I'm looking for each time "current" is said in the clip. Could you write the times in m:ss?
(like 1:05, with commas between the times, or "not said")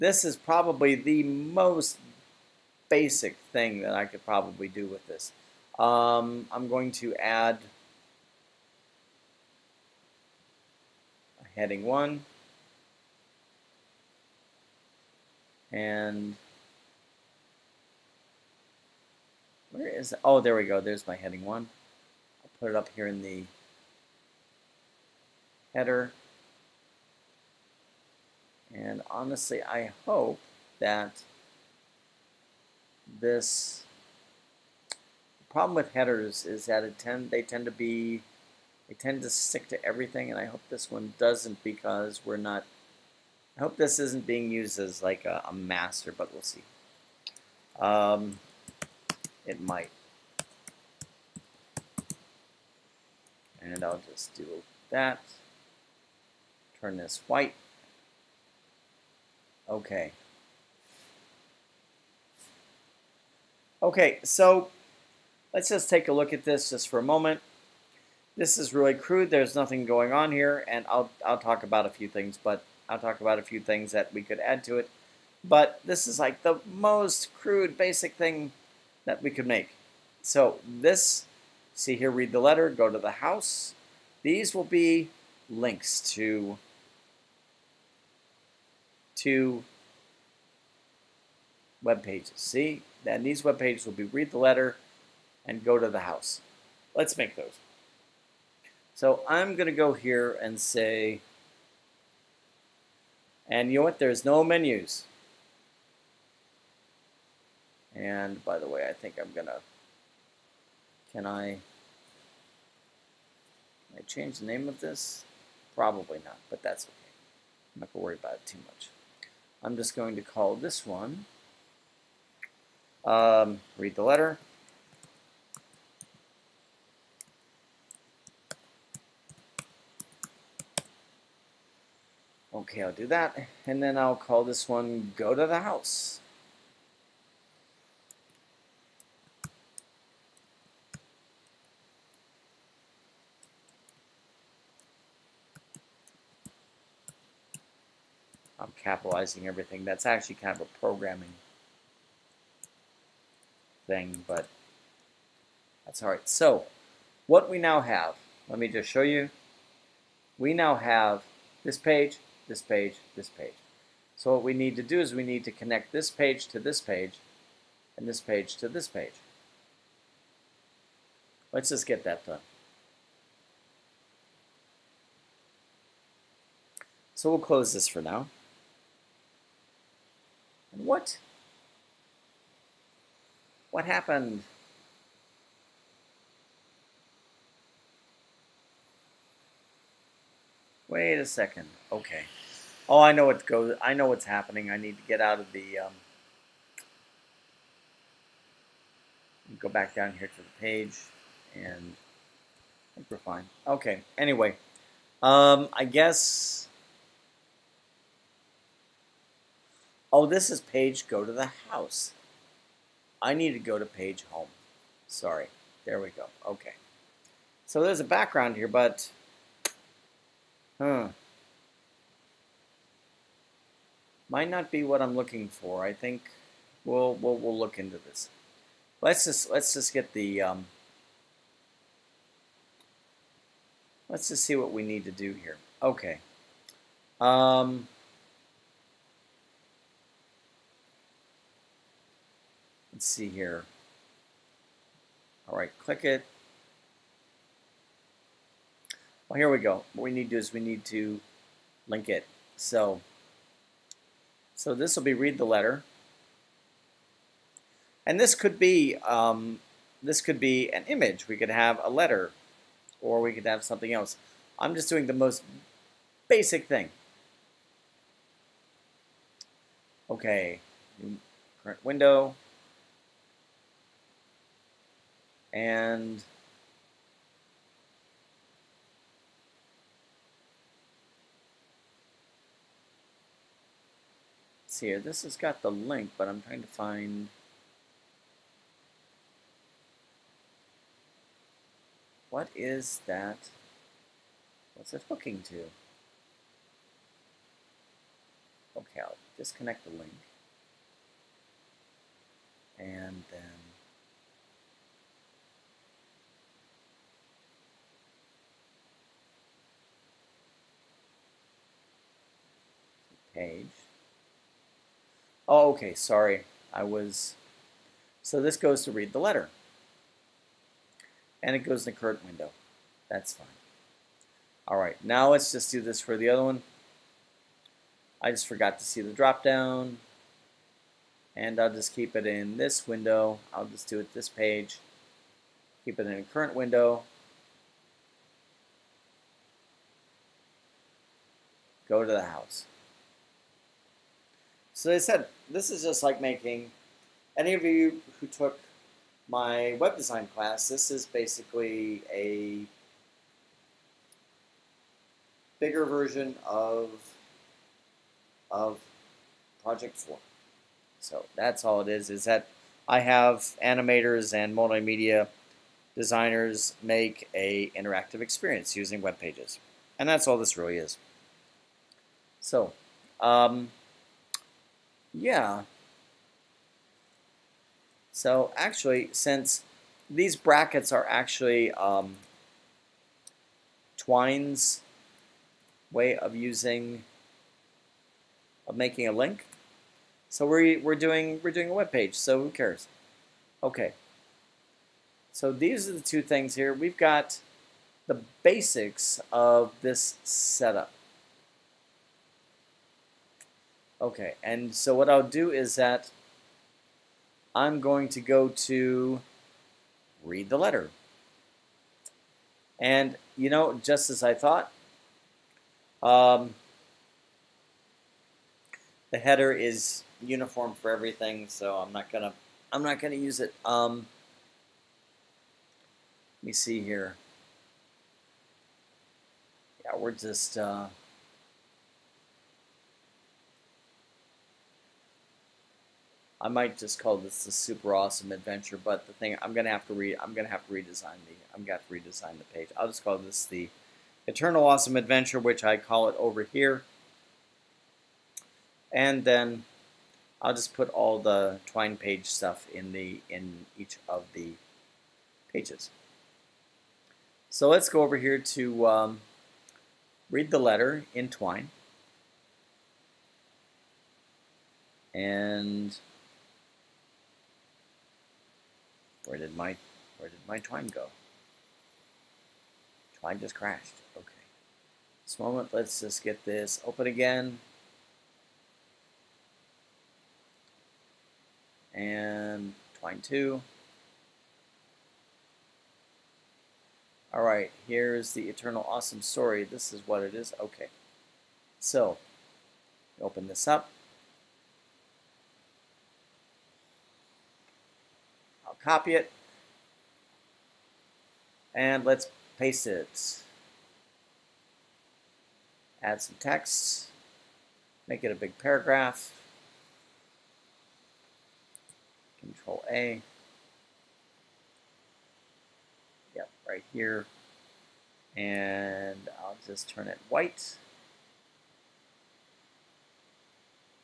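4:31, 5:21, 5:36.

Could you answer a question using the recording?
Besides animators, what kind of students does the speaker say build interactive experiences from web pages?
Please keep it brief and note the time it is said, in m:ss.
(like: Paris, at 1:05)
Multimedia designers, at 6:04.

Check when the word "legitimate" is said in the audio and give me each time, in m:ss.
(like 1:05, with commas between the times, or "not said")
not said.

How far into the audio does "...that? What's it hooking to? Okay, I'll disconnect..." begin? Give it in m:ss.
4:53.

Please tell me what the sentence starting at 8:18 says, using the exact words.
copy it, and let's paste it.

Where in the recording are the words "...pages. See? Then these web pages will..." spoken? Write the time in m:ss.
1:32.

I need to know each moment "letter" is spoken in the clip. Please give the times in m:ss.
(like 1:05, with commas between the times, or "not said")
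1:22, 1:34, 2:04, 4:15, 4:21, 5:19, 6:50, 7:40.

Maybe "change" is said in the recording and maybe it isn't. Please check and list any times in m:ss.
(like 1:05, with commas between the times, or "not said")
1:54.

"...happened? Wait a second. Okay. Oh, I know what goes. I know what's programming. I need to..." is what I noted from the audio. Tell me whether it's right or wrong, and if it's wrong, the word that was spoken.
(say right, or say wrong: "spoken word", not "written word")
wrong: "happening", not "programming".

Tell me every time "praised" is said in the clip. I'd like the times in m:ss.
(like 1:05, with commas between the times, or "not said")
not said.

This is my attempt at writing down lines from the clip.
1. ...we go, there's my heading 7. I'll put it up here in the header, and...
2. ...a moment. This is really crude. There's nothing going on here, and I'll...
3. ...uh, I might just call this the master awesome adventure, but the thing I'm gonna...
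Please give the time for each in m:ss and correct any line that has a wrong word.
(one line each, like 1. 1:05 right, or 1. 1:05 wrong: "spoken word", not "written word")
1. 0:20 wrong: "1", not "7"
2. 1:06 right
3. 7:10 wrong: "super", not "master".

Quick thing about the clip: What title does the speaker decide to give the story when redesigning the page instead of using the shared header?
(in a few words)
The Eternal Awesome Adventure.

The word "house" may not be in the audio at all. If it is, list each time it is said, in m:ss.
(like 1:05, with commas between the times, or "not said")
1:23, 1:35, 2:15, 3:31, 5:42.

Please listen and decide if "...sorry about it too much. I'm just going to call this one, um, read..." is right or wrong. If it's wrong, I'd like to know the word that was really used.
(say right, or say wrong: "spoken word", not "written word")
wrong: "worry", not "sorry".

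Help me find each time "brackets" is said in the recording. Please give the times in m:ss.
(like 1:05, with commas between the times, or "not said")
6:20.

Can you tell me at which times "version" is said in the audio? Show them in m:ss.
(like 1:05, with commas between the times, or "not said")
5:55.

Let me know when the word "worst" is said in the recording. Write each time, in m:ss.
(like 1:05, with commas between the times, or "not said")
not said.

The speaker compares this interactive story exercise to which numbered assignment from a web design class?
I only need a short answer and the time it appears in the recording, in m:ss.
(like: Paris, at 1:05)
Project 4, at 5:59.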